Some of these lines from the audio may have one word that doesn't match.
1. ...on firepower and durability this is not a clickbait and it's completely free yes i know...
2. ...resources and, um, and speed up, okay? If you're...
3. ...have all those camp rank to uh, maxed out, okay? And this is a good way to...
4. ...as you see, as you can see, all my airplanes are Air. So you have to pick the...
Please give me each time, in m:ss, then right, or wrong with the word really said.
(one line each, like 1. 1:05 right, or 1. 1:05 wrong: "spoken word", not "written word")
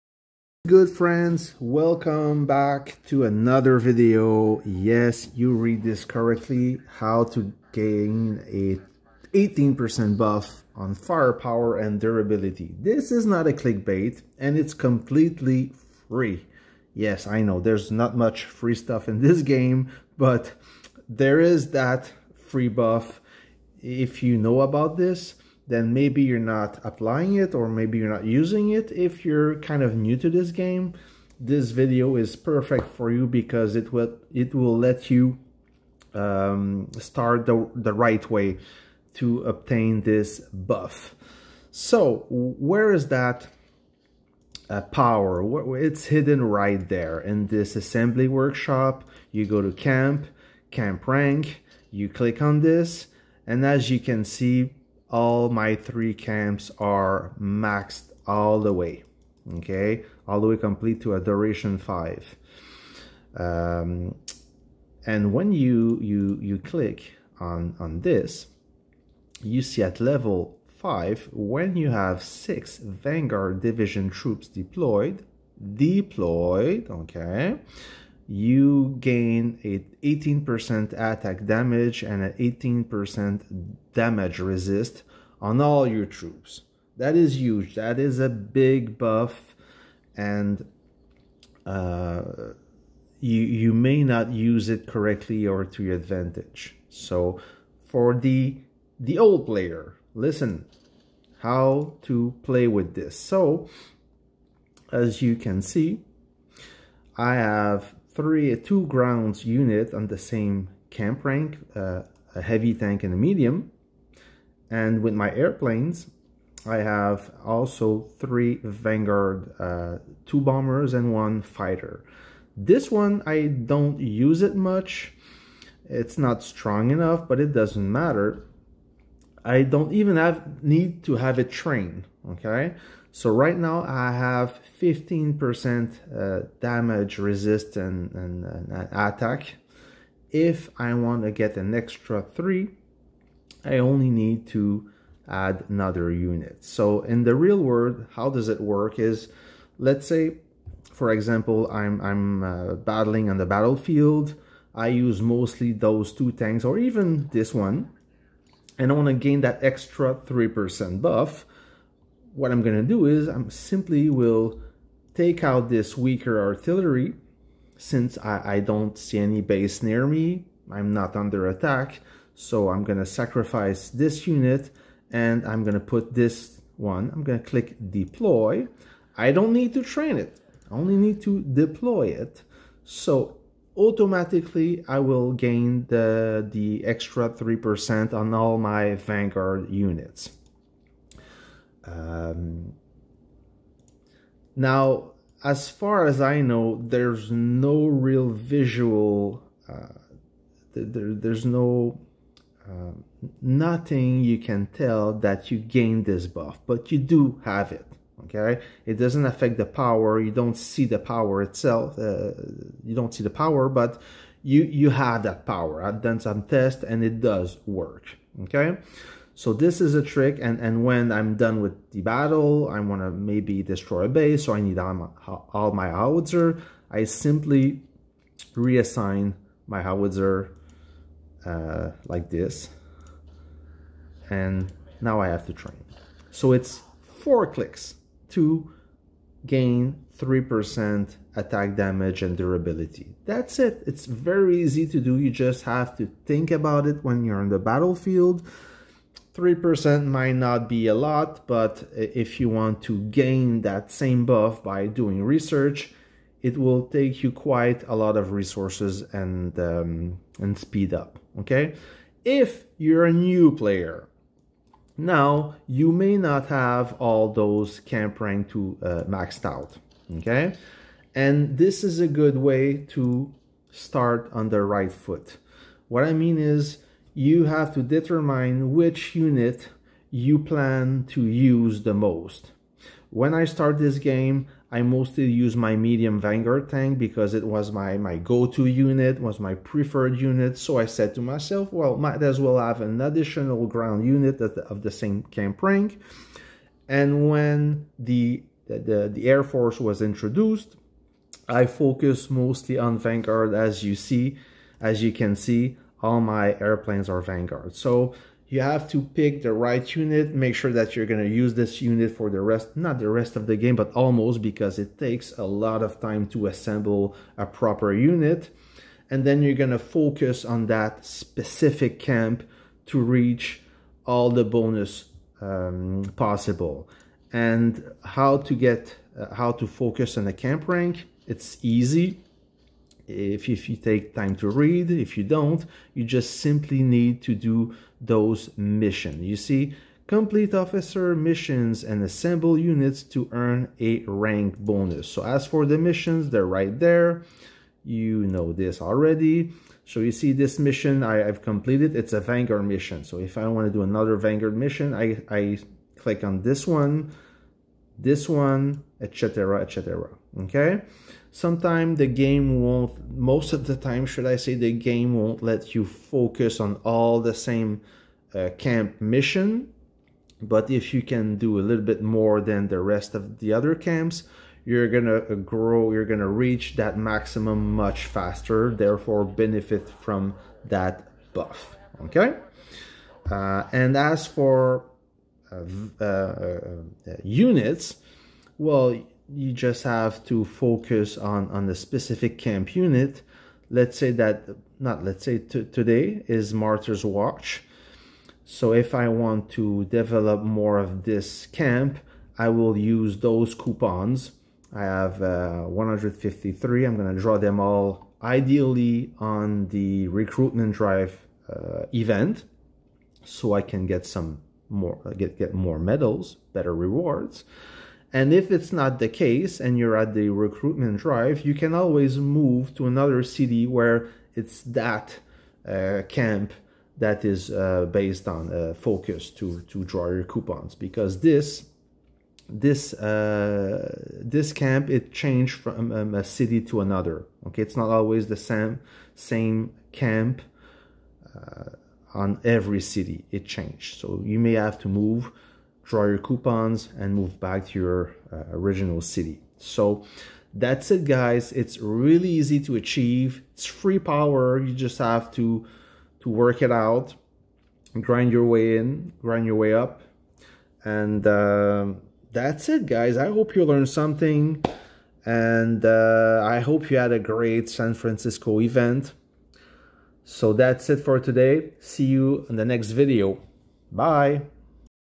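1. 0:10 right
2. 4:18 right
3. 4:26 right
4. 5:03 wrong: "Vanguard", not "Air".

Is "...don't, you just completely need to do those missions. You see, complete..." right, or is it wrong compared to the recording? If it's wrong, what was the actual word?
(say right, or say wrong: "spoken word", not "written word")
wrong: "simply", not "completely".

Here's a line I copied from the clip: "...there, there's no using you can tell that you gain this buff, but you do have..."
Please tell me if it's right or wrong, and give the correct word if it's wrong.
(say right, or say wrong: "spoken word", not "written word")
wrong: "nothing", not "using".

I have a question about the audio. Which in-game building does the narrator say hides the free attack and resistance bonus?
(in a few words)
assembly workshop.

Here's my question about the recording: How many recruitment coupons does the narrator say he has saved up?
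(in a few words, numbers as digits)
153.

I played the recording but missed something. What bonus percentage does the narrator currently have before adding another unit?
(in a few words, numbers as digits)
15%.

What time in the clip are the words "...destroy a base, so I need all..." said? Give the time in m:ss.
3:43.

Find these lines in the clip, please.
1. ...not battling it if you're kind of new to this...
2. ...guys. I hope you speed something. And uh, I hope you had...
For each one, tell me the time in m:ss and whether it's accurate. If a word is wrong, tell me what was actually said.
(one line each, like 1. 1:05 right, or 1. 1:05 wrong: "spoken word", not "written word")
1. 0:28 wrong: "using", not "battling"
2. 7:42 wrong: "learned", not "speed".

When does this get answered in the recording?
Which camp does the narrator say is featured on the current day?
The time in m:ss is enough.
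6:36.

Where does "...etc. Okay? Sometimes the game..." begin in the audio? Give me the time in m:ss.
5:59.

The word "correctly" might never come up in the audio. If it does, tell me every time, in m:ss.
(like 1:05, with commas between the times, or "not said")
0:06, 1:34.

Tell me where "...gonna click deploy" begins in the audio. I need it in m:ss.
2:57.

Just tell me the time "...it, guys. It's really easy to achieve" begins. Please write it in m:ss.
7:30.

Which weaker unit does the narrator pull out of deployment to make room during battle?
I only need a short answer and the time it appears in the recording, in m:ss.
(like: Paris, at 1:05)
artillery, at 2:46.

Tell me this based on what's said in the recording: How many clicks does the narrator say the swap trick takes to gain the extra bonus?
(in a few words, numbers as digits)
4.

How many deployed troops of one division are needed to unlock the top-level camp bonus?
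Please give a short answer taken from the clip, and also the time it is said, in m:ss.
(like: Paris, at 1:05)
6, at 1:12.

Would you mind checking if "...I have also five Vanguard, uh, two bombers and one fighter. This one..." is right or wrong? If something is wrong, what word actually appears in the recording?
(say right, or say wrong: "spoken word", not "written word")
wrong: "three", not "five".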